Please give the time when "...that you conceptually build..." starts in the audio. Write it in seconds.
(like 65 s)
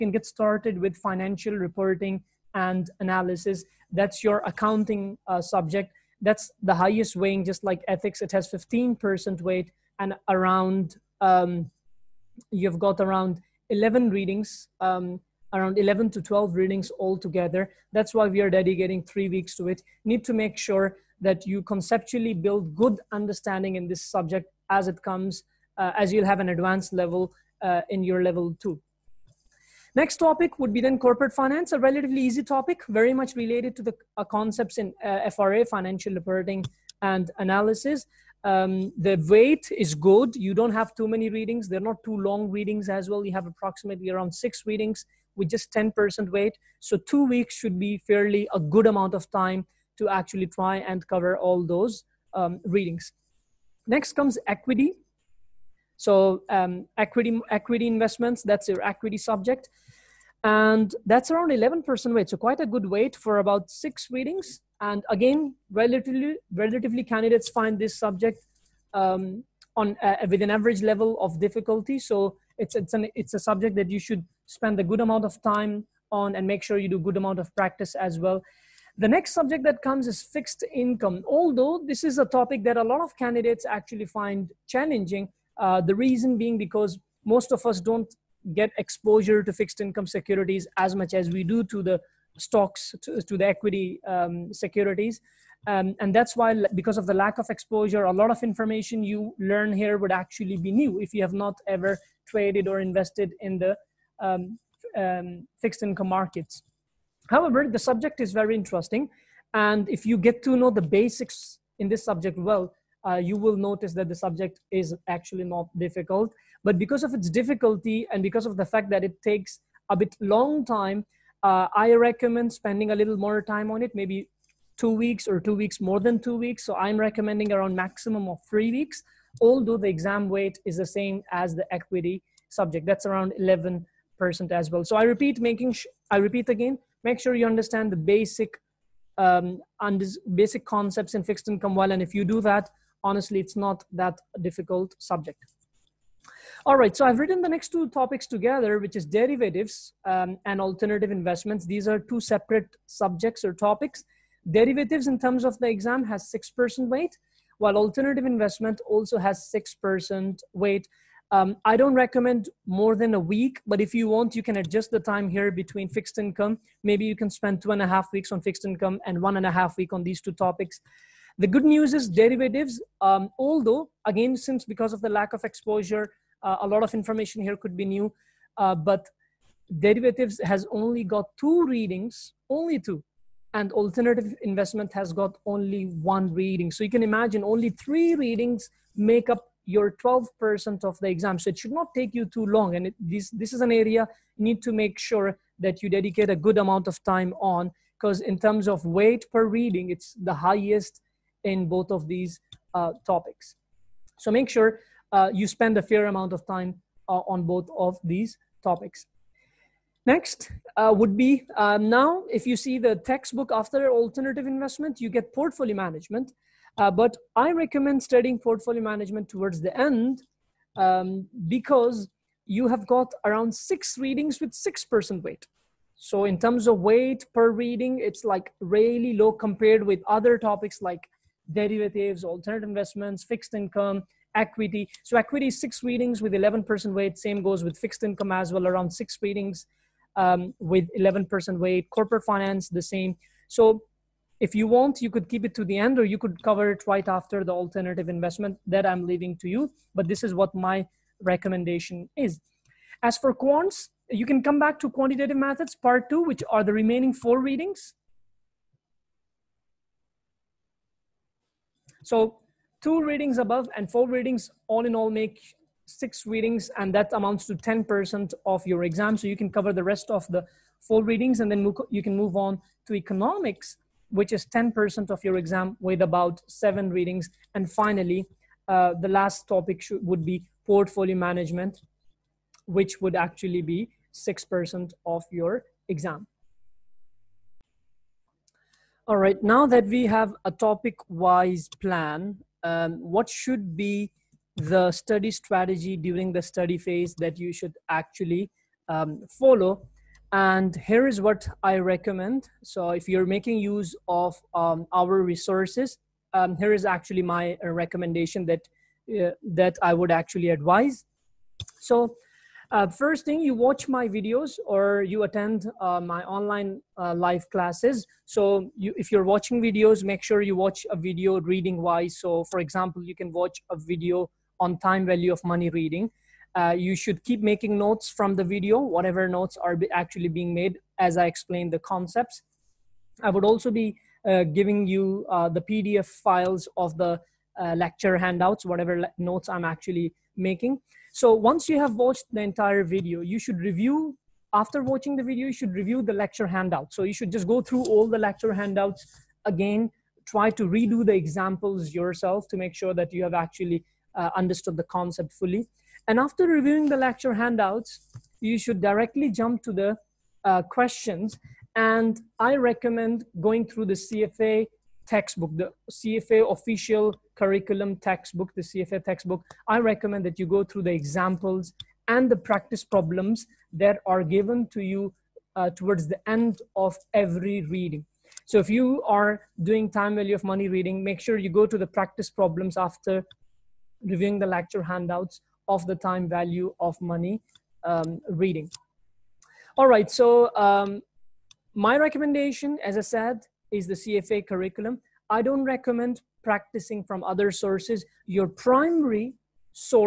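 21 s.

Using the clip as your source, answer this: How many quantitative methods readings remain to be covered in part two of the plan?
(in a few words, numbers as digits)
4.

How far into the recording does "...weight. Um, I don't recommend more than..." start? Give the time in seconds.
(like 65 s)
160 s.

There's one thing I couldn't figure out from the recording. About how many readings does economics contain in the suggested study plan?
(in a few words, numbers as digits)
7.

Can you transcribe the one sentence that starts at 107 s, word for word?
However, the subject is very interesting.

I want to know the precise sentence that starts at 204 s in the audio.
So make sure uh, you spend a fair amount of time uh, on both of these topics.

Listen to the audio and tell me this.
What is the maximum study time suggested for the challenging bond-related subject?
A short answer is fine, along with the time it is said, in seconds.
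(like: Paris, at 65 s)
3 weeks, at 127 s.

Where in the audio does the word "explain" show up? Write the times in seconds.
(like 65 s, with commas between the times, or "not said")
331 s.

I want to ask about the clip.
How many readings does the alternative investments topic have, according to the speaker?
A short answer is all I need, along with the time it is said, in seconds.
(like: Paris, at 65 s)
1, at 185 s.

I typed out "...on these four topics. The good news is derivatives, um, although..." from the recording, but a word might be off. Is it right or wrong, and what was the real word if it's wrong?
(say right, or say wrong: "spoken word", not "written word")
wrong: "two", not "four".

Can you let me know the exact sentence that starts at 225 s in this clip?
So in terms of weight per reading, it's like really low compared with other topics like derivatives, alternative investments, fixed income, equity.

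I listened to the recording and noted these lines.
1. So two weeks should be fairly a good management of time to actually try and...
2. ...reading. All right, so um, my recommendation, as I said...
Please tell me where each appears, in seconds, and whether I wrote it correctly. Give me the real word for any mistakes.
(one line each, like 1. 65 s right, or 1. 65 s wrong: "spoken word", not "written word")
1. 46 s wrong: "amount", not "management"
2. 388 s right.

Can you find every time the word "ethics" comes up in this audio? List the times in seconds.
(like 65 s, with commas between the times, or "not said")
7 s.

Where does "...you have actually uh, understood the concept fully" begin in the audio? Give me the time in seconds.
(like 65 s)
353 s.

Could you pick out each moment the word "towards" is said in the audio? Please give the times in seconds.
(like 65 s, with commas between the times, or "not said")
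219 s, 375 s.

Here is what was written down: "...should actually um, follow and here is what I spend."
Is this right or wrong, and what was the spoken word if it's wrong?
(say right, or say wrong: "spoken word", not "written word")
wrong: "recommend", not "spend".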